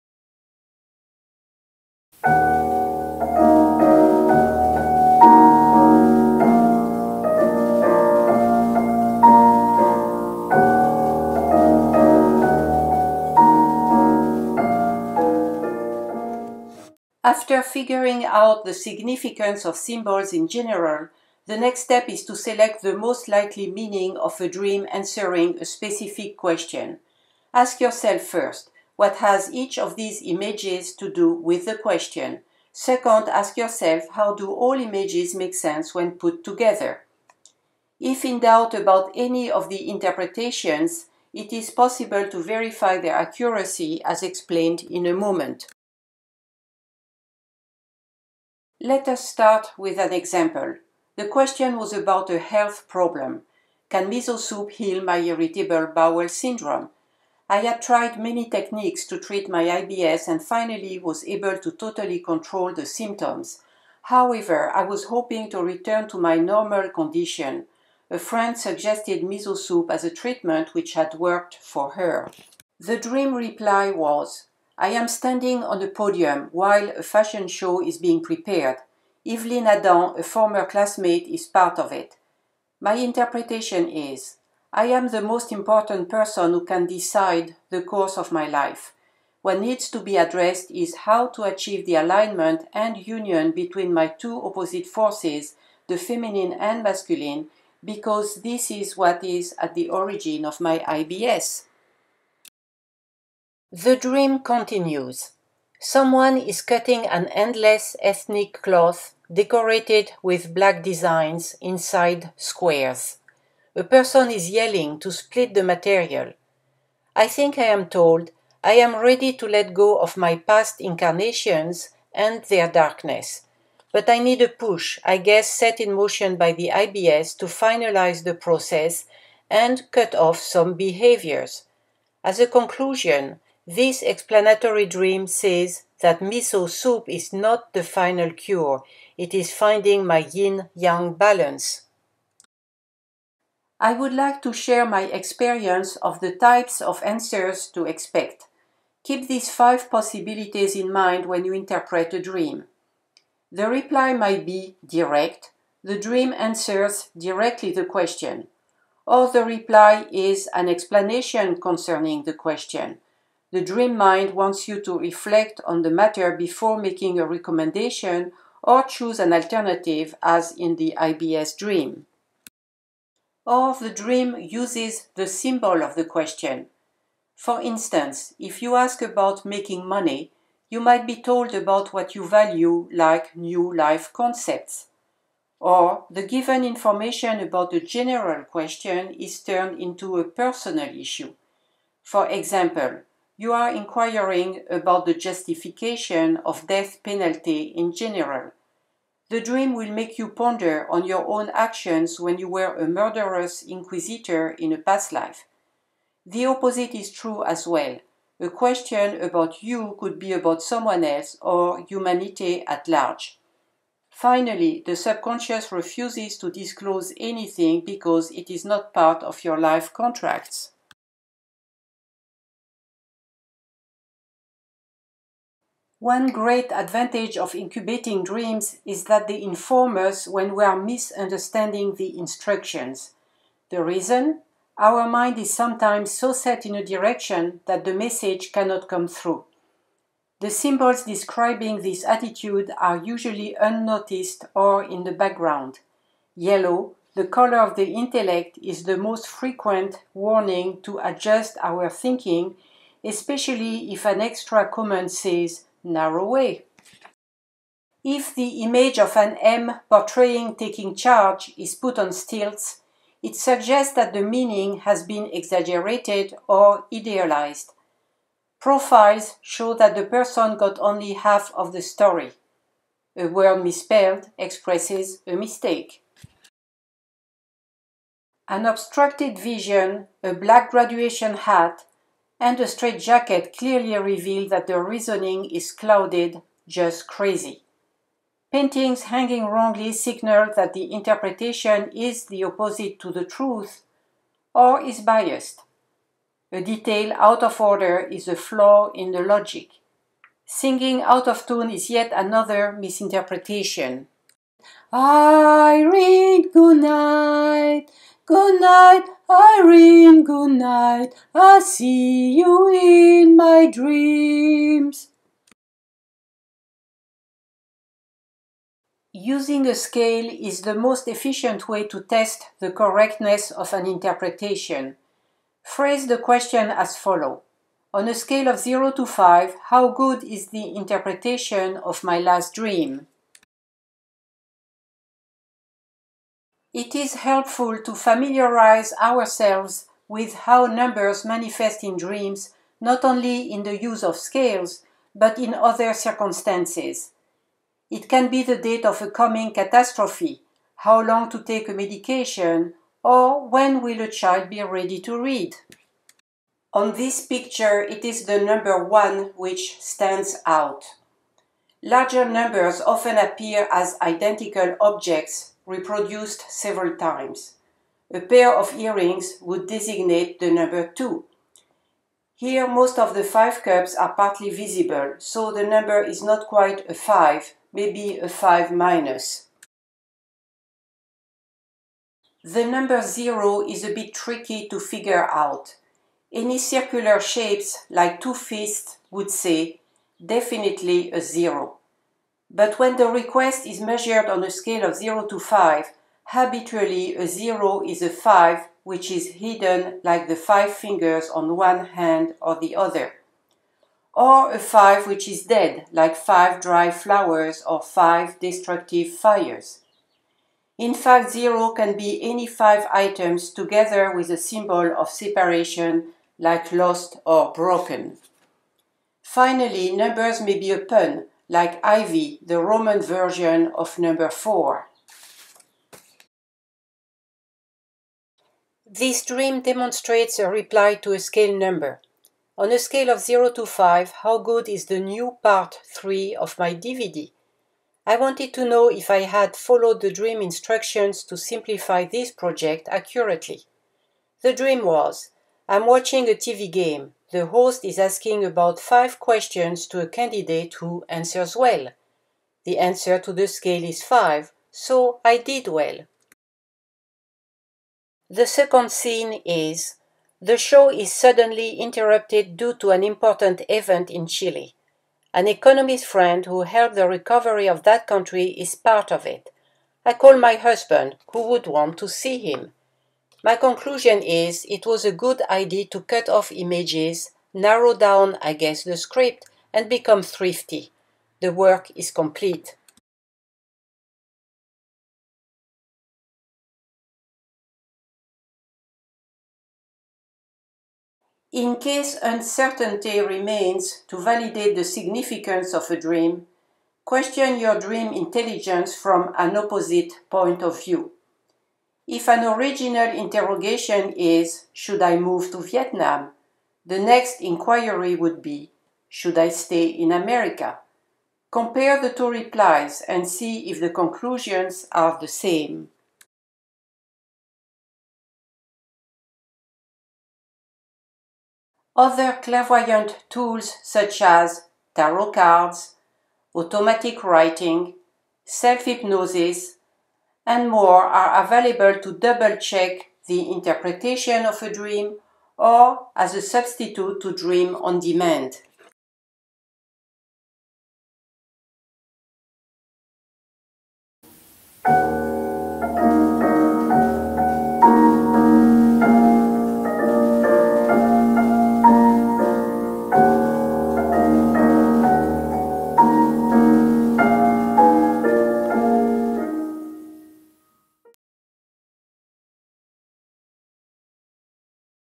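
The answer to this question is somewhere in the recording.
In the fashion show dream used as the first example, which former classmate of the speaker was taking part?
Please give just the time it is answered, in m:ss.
1:19.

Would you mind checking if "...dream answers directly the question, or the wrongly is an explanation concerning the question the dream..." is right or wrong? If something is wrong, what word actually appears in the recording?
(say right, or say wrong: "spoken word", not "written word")
wrong: "reply", not "wrongly".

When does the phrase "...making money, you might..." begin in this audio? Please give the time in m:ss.
2:59.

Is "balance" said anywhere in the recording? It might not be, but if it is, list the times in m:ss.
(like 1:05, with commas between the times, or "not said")
2:21.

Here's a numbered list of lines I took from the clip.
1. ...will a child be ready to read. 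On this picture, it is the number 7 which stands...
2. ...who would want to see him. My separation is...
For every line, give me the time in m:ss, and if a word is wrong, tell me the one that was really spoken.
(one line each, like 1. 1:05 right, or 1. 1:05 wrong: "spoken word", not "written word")
1. 5:53 wrong: "1", not "7"
2. 7:51 wrong: "conclusion", not "separation".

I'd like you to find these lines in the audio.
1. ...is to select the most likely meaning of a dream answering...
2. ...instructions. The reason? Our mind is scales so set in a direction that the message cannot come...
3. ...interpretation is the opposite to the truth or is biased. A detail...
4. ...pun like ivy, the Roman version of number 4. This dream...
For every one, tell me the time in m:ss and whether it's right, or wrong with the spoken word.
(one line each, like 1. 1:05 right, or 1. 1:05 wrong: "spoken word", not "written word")
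1. 0:22 right
2. 3:52 wrong: "sometimes", not "scales"
3. 4:50 right
4. 7:00 right.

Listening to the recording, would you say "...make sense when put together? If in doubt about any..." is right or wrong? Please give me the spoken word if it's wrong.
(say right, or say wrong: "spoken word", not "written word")
right.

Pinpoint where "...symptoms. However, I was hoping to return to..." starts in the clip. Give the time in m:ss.
1:02.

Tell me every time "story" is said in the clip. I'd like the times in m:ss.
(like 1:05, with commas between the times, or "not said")
4:31.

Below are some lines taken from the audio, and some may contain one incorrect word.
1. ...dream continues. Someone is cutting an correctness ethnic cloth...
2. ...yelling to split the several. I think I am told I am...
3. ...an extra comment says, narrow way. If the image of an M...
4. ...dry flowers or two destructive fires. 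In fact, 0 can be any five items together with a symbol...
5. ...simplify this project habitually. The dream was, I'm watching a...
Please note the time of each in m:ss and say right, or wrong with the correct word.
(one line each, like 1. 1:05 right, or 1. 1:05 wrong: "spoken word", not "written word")
1. 1:43 wrong: "endless", not "correctness"
2. 1:54 wrong: "material", not "several"
3. 4:14 right
4. 6:46 wrong: "five", not "two"
5. 7:21 wrong: "accurately", not "habitually".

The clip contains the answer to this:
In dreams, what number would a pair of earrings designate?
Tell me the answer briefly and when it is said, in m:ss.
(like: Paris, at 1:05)
2, at 6:10.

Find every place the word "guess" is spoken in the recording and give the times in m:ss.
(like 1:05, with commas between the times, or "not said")
2:05, 7:58.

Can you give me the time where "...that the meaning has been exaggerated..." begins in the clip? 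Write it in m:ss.
4:23.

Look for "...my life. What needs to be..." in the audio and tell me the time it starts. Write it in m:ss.
1:28.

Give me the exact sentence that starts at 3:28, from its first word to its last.
A question about you could be about someone else or humanity at large.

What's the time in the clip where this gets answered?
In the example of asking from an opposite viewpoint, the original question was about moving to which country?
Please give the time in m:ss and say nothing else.
8:25.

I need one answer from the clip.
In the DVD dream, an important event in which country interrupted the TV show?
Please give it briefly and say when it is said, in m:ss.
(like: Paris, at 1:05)
Chile, at 7:44.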